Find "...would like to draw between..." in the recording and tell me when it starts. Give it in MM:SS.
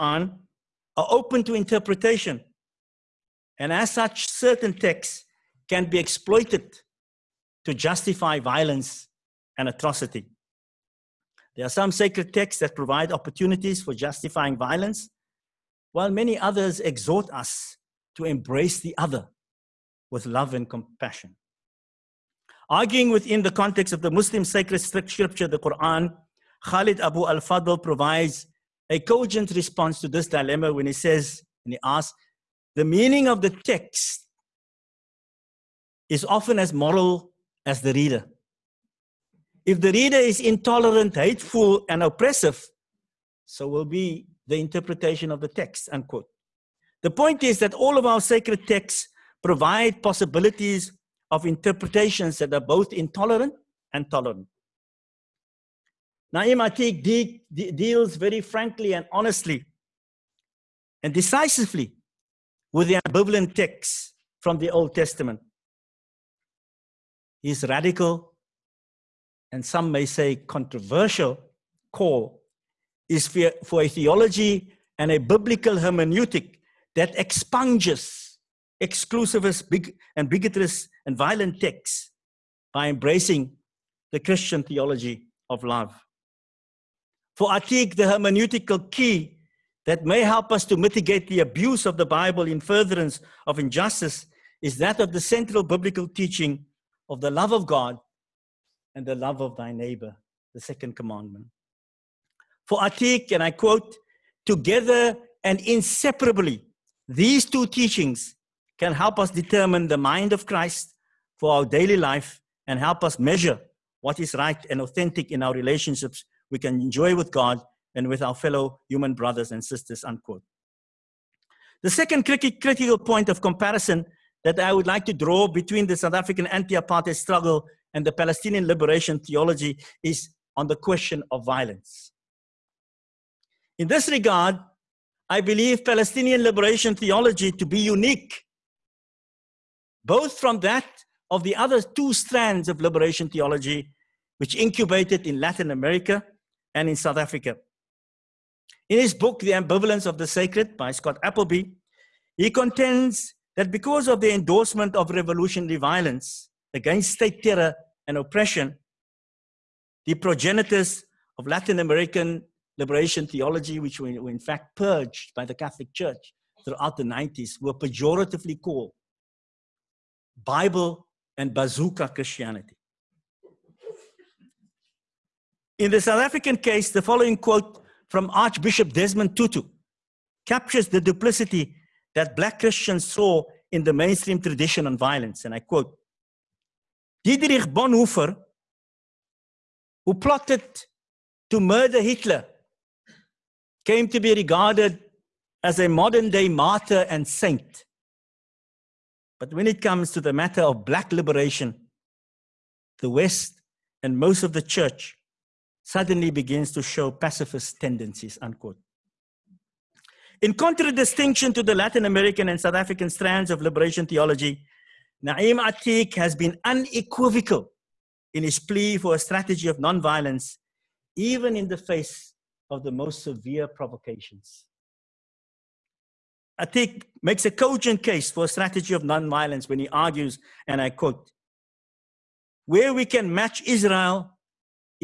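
02:04.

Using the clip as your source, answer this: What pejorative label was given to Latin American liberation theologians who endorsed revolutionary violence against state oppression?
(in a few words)
Bible and bazooka Christianity.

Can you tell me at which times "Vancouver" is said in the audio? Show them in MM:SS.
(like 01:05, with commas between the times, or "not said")
not said.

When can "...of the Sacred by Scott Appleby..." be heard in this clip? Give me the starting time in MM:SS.
02:30.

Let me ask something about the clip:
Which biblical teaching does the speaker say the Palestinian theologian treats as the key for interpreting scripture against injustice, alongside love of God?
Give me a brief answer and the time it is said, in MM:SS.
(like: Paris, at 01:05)
love of thy neighbor, at 01:39.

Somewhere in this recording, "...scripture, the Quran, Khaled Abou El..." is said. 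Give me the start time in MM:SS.
00:24.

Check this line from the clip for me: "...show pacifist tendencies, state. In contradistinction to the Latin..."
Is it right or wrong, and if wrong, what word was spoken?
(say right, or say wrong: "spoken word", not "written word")
wrong: "unquote", not "state".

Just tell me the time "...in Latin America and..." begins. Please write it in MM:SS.
02:25.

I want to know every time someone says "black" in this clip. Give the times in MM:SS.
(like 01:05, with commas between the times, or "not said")
03:02, 03:20.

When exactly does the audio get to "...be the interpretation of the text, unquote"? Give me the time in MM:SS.
00:43.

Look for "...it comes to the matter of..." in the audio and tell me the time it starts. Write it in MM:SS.
03:19.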